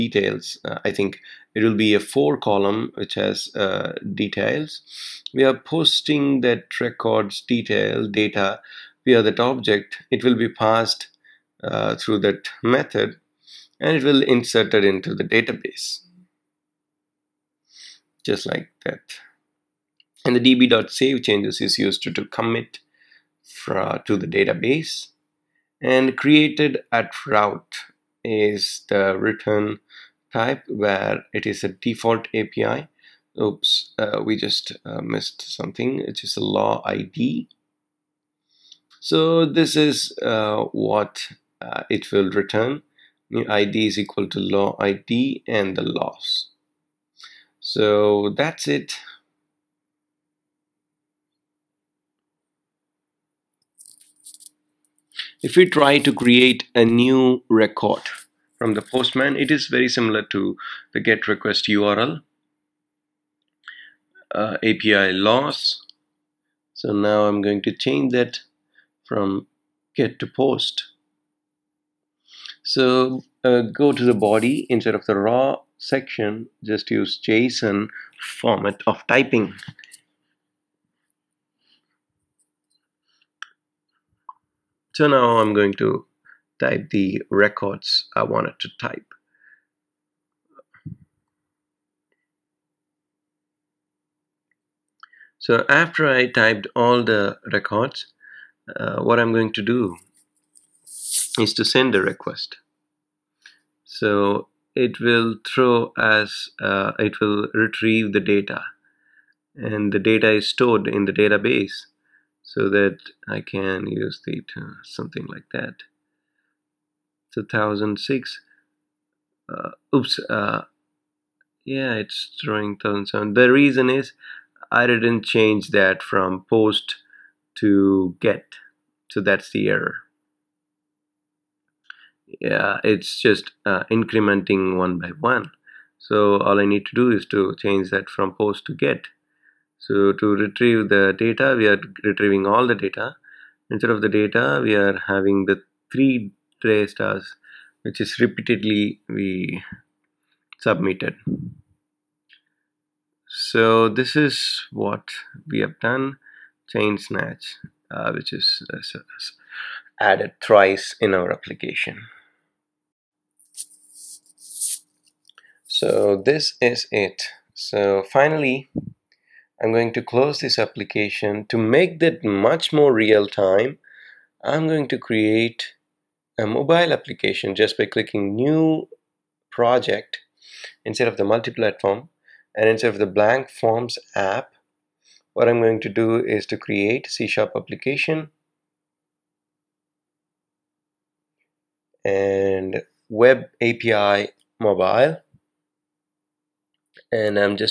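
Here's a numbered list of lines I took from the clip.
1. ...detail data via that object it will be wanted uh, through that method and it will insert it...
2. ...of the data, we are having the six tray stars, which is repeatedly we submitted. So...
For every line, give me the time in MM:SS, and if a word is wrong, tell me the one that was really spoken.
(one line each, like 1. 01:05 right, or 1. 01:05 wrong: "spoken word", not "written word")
1. 00:07 wrong: "passed", not "wanted"
2. 02:23 wrong: "three", not "six".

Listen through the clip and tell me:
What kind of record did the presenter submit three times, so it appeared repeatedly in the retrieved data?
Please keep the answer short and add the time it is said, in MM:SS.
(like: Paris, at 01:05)
Chain snatch, at 02:36.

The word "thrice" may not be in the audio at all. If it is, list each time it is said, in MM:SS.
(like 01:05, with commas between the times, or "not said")
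02:40.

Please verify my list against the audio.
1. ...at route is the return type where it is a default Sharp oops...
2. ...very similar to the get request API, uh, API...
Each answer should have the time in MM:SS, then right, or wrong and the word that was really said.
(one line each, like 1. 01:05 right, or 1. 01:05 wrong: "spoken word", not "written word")
1. 00:26 wrong: "API", not "Sharp"
2. 00:59 wrong: "URL", not "API".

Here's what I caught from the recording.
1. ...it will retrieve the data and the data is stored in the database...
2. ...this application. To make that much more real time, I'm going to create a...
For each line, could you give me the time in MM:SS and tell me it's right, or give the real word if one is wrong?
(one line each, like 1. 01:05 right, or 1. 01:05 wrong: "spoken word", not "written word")
1. 01:46 right
2. 02:50 right.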